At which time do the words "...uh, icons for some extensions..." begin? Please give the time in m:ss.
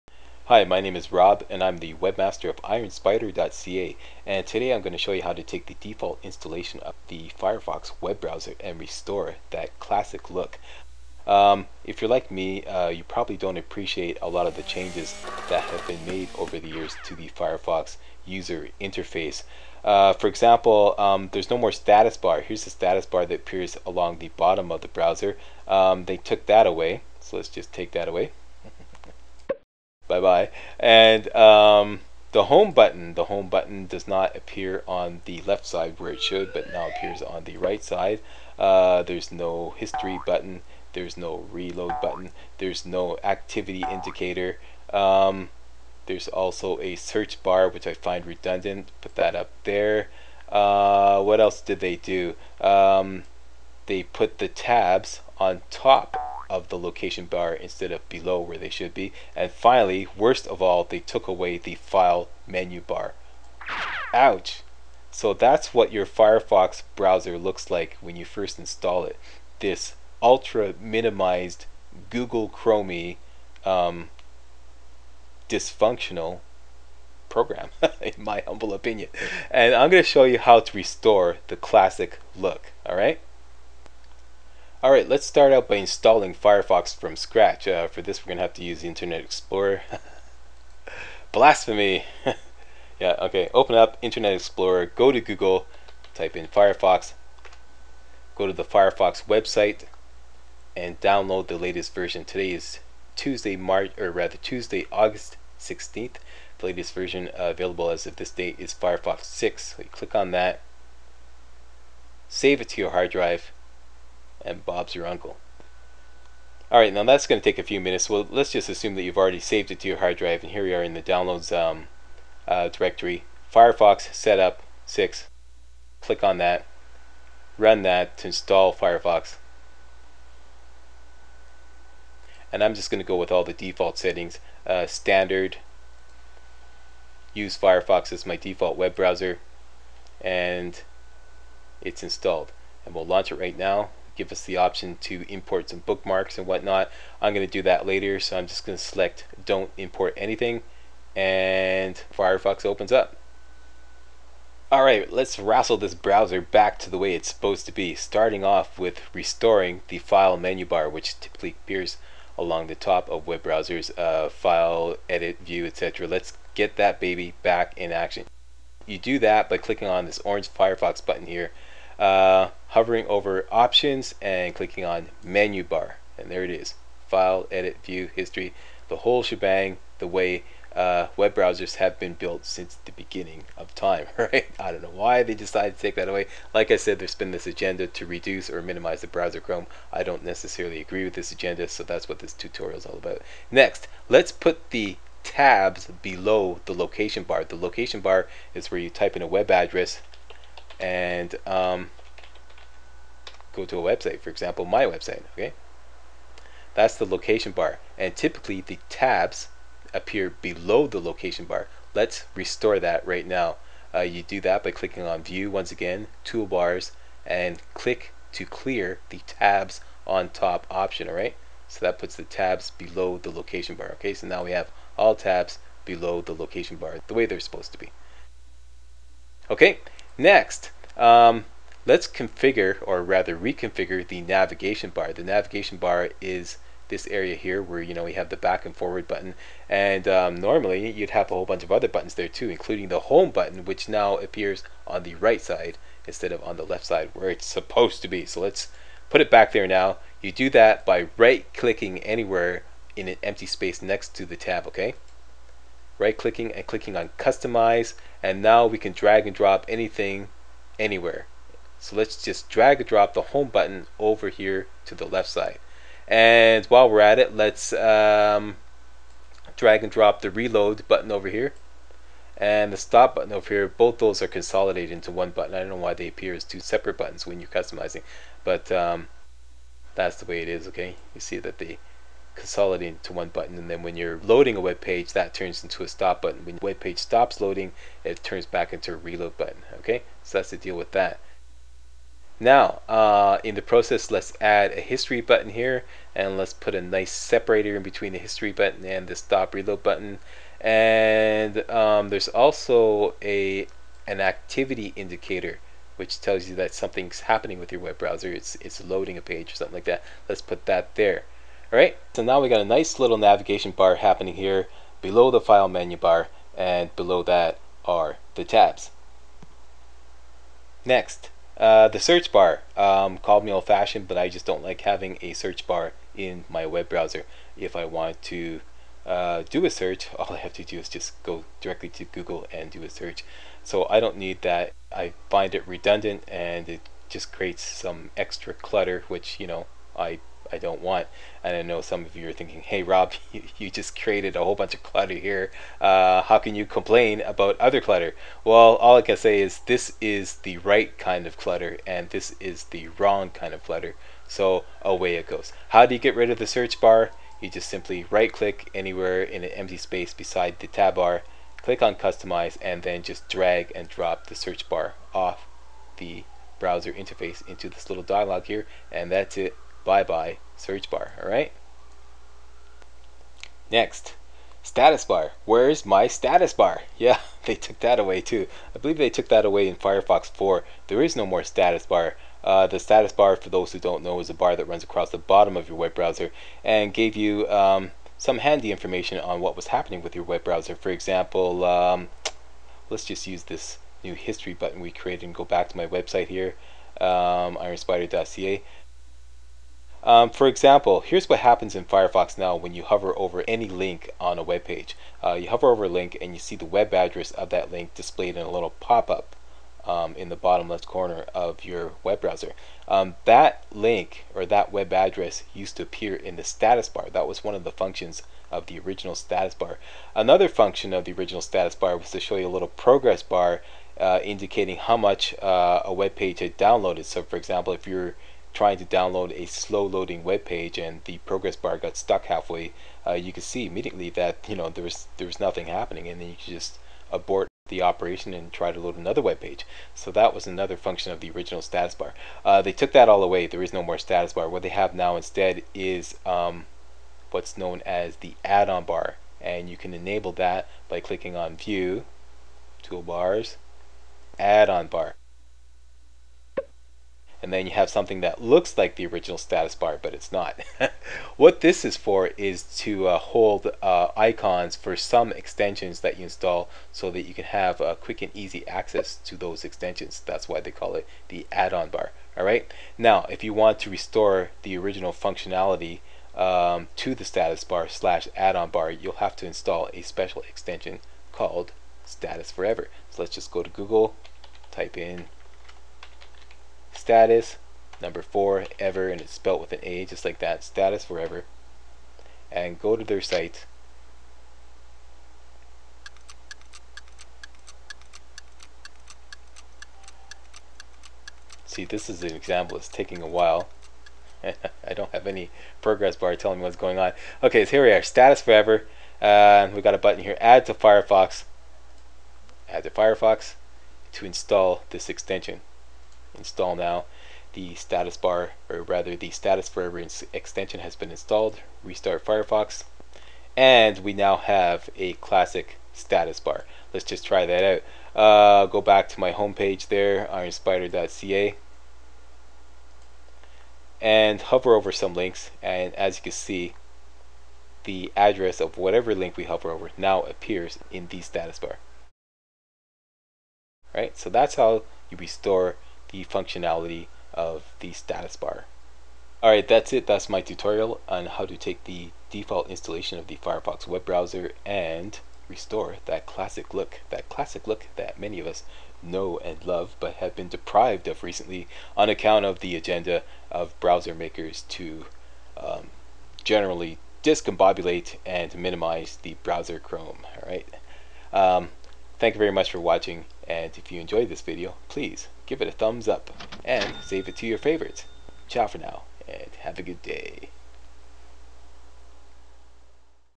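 7:43.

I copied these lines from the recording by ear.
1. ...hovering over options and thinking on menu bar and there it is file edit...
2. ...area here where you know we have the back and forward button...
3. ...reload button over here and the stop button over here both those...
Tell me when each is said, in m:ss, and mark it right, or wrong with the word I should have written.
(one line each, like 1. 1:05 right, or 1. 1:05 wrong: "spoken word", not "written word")
1. 2:52 wrong: "clicking", not "thinking"
2. 3:57 right
3. 4:30 right.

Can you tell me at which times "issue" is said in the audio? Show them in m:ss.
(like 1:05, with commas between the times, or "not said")
not said.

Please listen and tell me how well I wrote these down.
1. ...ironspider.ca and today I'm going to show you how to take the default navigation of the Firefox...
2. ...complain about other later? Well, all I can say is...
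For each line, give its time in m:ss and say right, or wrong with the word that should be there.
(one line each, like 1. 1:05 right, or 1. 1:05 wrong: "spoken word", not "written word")
1. 0:02 wrong: "installation", not "navigation"
2. 5:46 wrong: "clutter", not "later".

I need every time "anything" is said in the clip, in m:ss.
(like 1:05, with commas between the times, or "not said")
2:30, 4:19.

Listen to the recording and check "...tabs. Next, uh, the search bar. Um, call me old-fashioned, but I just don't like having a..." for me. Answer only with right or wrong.
right.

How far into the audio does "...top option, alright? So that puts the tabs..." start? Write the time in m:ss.
3:40.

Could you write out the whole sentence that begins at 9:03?
All right, so that's how you restore the functionality of the status bar.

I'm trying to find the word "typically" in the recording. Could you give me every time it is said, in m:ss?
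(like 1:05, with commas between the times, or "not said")
2:41, 3:28.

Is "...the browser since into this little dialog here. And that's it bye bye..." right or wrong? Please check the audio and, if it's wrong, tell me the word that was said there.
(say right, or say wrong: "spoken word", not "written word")
wrong: "interface", not "since".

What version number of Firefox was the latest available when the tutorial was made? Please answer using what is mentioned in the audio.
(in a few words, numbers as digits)
6.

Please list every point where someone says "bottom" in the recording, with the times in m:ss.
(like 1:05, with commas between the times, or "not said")
0:24, 6:25, 6:50.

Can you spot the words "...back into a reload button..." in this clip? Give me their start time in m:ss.
4:48.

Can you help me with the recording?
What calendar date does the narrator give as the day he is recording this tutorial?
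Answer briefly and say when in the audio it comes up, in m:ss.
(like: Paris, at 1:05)
August 16th, at 1:44.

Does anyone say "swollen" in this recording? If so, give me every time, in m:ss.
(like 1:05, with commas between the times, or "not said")
not said.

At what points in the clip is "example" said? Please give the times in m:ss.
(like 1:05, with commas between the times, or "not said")
0:20, 3:24, 6:30, 6:40, 7:07, 8:22.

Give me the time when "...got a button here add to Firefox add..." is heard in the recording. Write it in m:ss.
8:29.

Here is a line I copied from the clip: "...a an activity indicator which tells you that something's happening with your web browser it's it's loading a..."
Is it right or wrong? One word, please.
right.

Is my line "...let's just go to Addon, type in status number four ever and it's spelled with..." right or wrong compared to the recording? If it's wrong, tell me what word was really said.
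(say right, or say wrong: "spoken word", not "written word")
wrong: "Google", not "Addon".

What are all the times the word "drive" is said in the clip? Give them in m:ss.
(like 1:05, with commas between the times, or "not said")
1:53, 2:00.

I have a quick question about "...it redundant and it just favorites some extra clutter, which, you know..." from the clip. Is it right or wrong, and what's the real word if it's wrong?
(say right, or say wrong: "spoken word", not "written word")
wrong: "creates", not "favorites".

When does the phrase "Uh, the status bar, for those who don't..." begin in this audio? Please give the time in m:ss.
6:22.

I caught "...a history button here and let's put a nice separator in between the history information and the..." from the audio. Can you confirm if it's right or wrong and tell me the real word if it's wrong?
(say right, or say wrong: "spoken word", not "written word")
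wrong: "button", not "information".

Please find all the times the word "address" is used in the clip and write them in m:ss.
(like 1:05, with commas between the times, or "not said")
3:19, 6:46, 6:54, 8:58.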